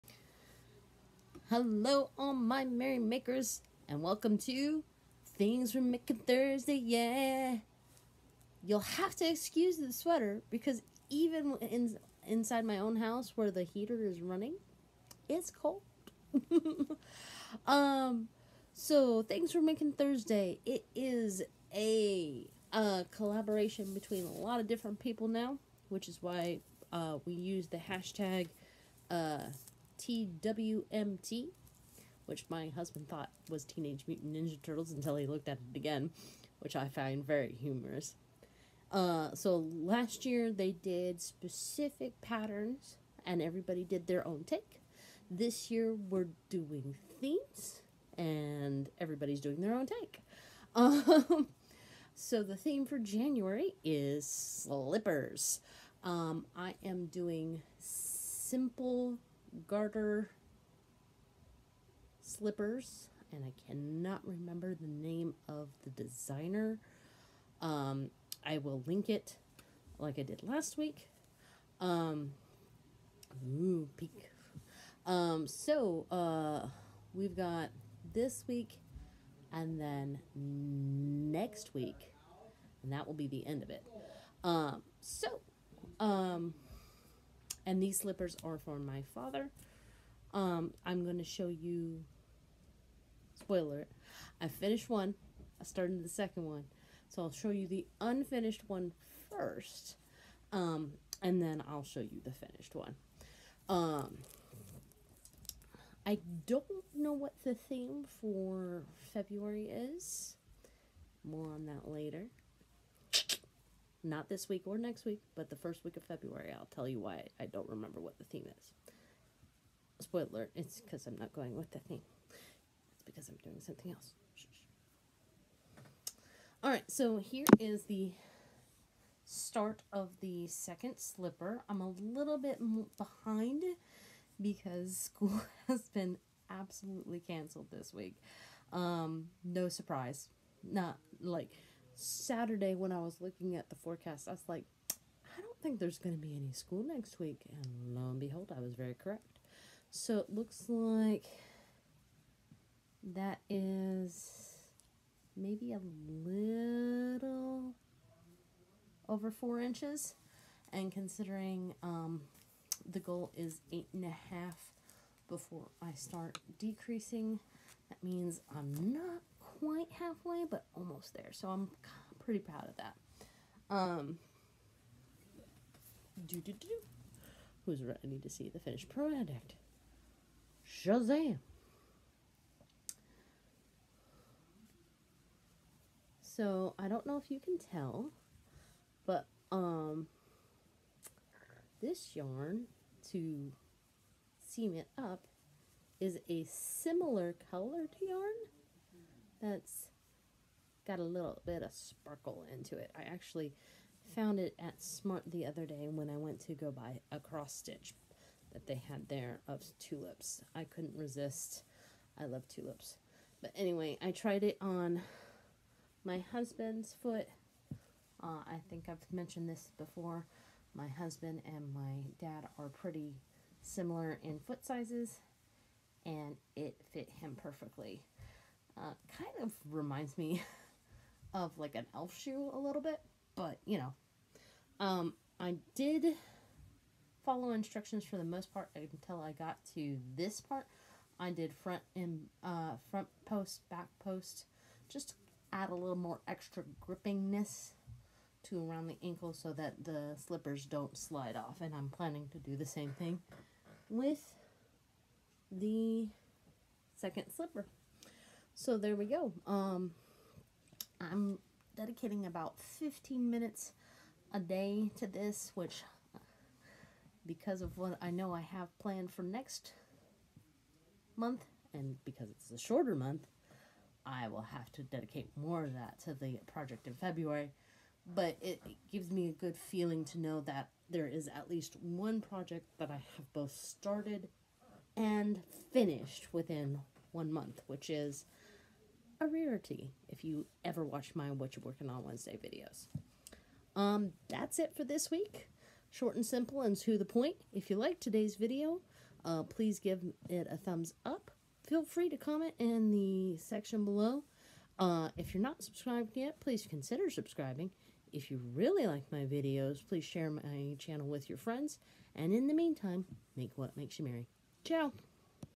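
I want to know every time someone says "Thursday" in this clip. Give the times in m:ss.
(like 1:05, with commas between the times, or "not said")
0:06, 0:19.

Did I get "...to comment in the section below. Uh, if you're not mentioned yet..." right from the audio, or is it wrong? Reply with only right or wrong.
wrong.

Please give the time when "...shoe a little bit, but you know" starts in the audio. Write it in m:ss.
3:52.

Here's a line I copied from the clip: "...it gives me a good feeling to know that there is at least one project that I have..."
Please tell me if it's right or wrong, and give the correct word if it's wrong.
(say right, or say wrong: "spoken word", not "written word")
right.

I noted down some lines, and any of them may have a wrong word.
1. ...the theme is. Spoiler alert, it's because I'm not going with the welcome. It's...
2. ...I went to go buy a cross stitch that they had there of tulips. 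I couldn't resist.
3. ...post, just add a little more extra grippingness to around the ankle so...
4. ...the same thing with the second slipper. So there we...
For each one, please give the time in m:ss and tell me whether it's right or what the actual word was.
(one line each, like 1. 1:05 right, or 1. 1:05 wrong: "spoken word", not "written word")
1. 1:58 wrong: "theme", not "welcome"
2. 3:26 right
3. 4:04 right
4. 4:12 right.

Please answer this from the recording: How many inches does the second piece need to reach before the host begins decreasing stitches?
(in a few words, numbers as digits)
8.5.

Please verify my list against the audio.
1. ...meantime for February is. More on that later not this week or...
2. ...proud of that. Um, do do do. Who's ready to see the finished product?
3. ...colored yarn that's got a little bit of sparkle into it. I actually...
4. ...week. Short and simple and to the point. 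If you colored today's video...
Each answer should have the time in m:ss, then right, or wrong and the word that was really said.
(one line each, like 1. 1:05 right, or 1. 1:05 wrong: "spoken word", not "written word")
1. 1:47 wrong: "theme", not "meantime"
2. 2:52 right
3. 3:17 right
4. 4:55 wrong: "liked", not "colored".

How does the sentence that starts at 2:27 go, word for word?
And lo and behold, I was very correct.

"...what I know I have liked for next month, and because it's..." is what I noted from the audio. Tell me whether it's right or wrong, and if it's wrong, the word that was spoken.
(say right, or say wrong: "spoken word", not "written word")
wrong: "planned", not "liked".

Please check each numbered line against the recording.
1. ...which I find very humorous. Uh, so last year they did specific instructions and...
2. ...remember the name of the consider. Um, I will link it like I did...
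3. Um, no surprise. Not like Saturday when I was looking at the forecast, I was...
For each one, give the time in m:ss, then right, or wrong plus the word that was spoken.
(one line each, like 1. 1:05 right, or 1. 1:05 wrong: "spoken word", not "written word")
1. 0:36 wrong: "patterns", not "instructions"
2. 1:04 wrong: "designer", not "consider"
3. 2:18 right.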